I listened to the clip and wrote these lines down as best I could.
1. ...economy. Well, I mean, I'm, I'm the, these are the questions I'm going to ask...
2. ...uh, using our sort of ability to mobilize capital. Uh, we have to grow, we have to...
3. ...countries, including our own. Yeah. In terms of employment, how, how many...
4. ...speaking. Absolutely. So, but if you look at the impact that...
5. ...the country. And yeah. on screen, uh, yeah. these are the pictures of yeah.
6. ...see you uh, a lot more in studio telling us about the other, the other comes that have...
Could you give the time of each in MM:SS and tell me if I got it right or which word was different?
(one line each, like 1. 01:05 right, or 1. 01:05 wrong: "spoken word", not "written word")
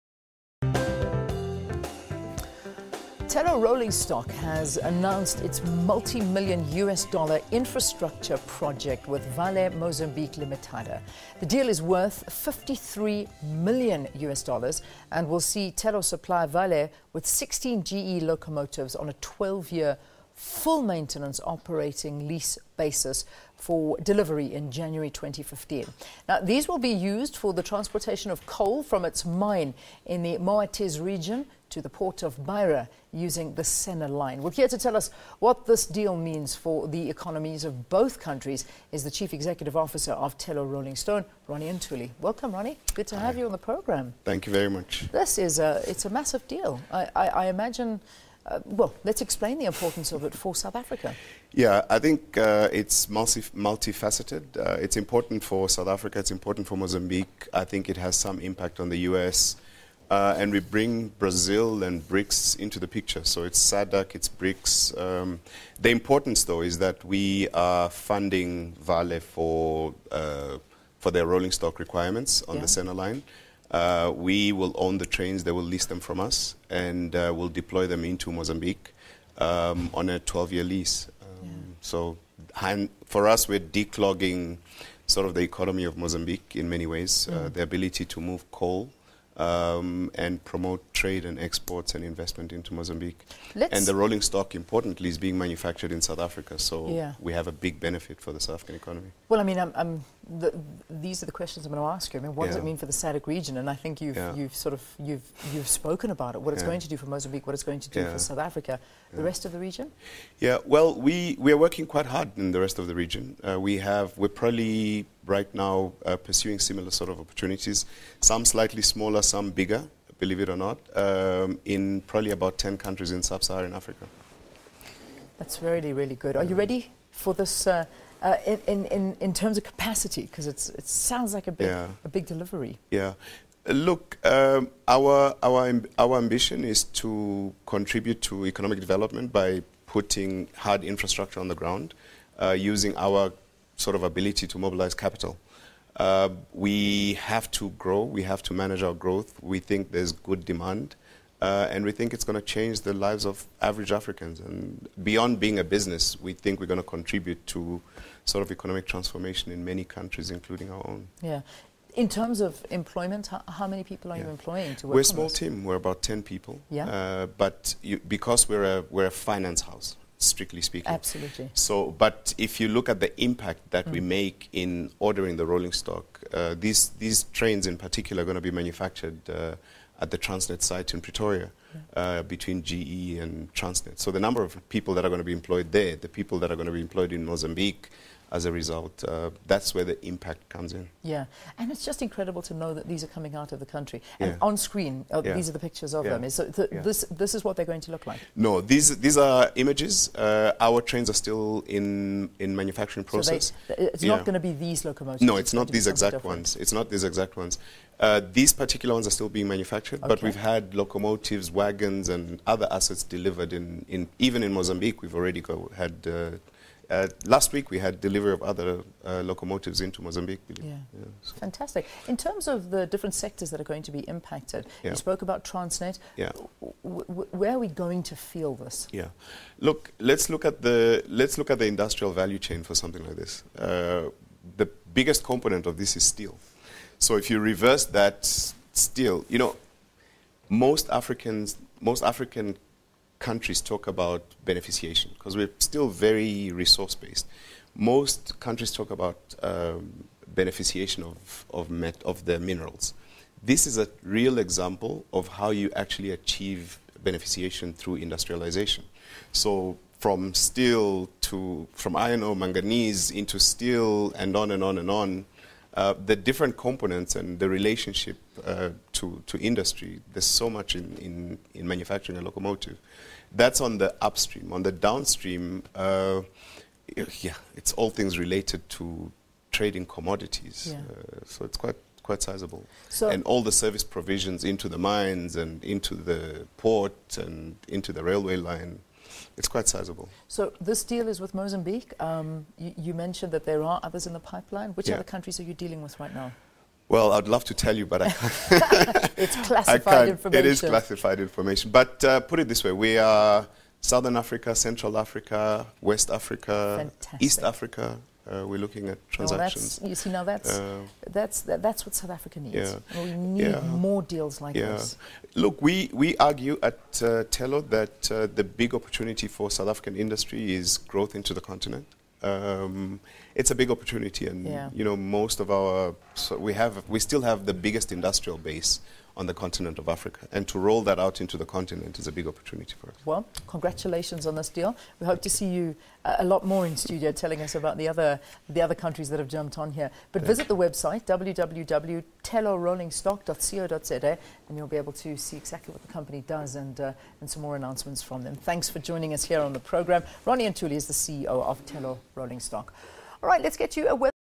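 1. 01:38 right
2. 02:22 right
3. 02:39 right
4. 02:50 right
5. 03:13 right
6. 05:35 wrong: "countries", not "comes".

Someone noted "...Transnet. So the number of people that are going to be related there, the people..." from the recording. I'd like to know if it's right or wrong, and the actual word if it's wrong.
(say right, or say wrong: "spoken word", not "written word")
wrong: "employed", not "related".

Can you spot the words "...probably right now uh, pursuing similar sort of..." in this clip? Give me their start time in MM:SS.
01:54.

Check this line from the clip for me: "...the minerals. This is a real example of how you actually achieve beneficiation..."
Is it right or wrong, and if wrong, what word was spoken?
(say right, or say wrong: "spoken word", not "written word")
right.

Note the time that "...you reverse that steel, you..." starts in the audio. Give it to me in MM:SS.
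03:57.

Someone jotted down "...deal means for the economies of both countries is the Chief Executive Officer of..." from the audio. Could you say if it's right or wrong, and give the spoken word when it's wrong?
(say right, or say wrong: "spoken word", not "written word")
right.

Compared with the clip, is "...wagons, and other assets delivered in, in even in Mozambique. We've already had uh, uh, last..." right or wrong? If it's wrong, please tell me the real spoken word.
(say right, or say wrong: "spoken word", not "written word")
right.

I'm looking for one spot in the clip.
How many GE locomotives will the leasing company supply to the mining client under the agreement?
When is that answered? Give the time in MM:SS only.
00:17.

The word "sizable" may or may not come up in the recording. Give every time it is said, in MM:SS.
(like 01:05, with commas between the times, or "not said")
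04:42, 04:49.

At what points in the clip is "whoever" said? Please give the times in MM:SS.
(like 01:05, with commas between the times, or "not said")
not said.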